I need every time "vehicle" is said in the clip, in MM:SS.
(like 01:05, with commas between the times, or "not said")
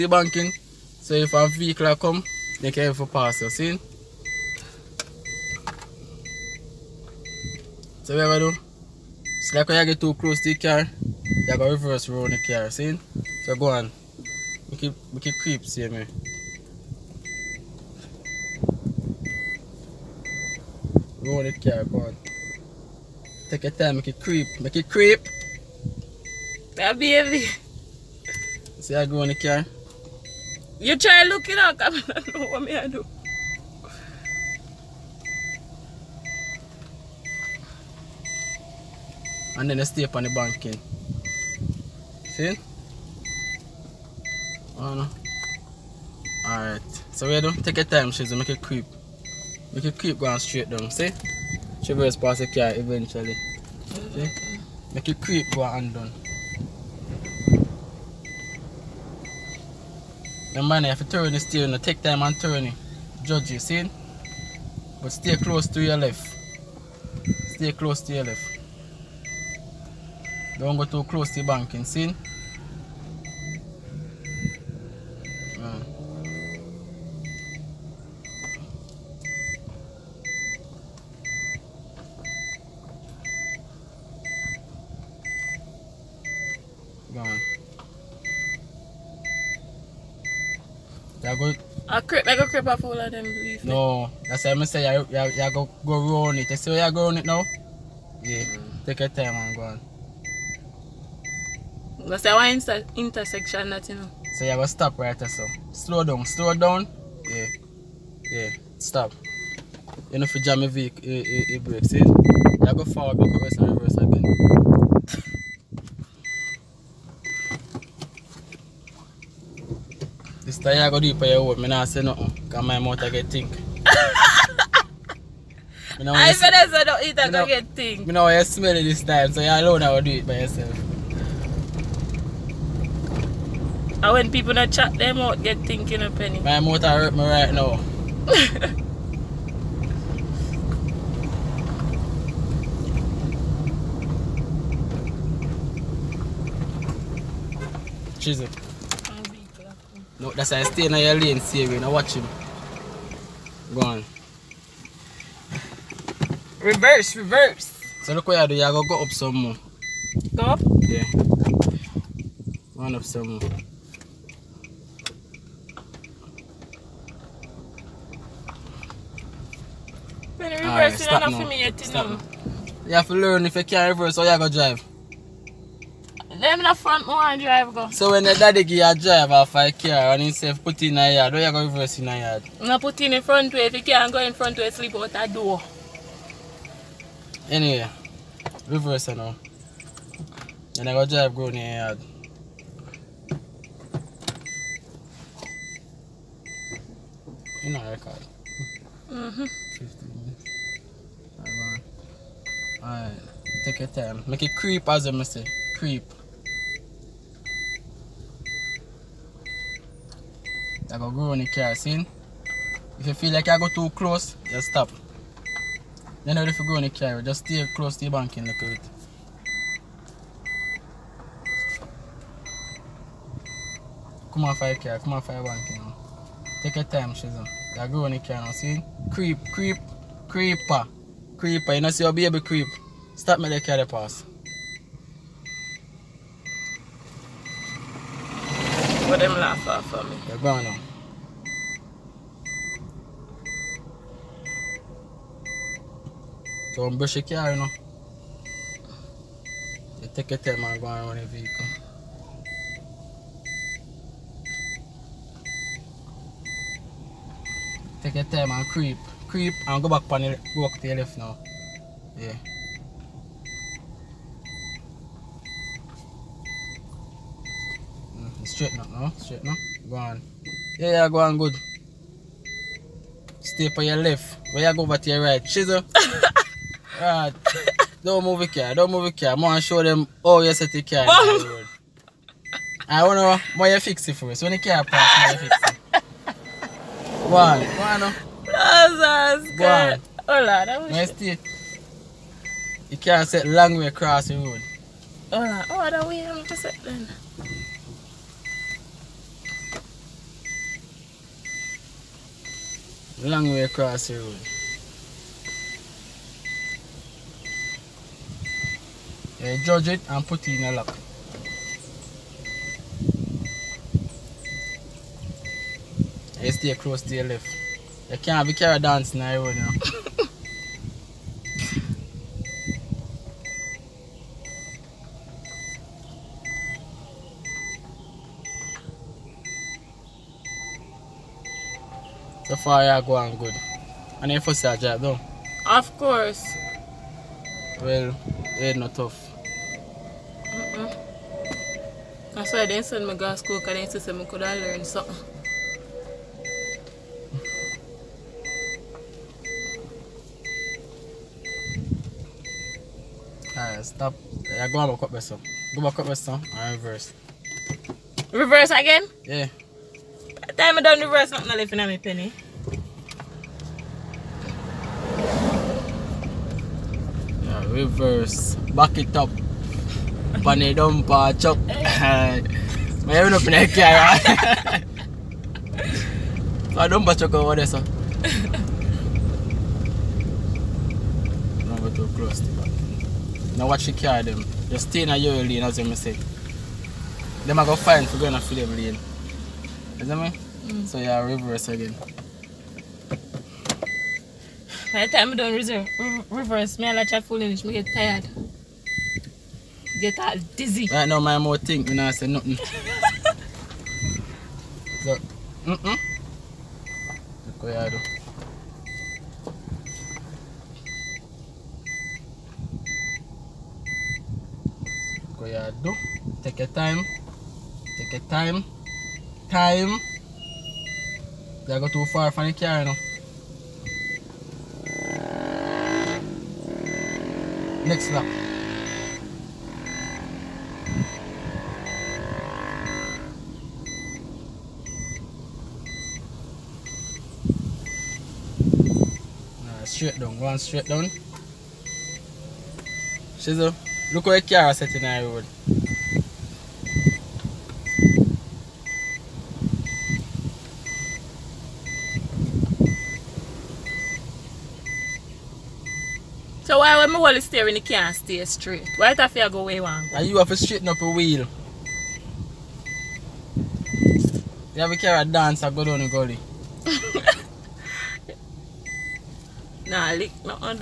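00:01, 01:50, 04:11.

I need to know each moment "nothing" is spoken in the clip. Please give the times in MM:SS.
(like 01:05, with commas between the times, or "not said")
02:02, 06:42.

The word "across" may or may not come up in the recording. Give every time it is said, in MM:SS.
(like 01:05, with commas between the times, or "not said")
04:53, 05:03.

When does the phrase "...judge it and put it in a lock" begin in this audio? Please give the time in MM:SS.
05:09.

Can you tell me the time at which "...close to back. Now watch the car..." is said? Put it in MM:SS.
06:22.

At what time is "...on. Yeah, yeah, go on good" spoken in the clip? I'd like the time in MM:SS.
04:29.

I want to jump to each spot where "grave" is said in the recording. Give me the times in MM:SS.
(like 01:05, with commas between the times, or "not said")
not said.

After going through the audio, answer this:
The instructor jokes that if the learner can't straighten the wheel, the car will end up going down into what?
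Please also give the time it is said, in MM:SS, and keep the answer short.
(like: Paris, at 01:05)
gully, at 07:46.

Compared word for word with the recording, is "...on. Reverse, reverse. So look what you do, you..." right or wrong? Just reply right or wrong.
right.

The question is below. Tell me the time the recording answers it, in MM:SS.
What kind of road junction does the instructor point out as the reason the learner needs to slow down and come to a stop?
01:42.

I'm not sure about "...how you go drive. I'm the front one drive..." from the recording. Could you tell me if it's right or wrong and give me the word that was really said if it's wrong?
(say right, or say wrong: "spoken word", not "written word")
right.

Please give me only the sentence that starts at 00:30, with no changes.
You try looking out, I don't know what me I do.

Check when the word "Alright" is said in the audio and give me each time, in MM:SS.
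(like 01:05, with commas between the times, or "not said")
00:46, 03:22, 05:53.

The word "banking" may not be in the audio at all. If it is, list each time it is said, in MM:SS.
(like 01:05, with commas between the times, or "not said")
00:00, 00:40, 01:11, 03:38, 03:45.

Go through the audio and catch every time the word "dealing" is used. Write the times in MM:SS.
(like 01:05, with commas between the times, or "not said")
not said.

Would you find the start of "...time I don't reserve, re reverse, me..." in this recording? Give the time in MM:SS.
06:35.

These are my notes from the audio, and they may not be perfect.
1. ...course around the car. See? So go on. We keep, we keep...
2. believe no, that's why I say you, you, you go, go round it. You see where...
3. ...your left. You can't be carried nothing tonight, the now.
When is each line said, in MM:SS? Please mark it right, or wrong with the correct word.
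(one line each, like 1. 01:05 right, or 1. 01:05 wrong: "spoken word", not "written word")
1. 00:11 wrong: "reverse", not "course"
2. 01:33 right
3. 05:17 wrong: "dancing", not "nothing".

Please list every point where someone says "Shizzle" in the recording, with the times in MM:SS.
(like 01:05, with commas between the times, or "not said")
03:47, 07:23.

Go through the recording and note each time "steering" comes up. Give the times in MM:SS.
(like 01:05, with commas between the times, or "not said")
01:01, 07:37.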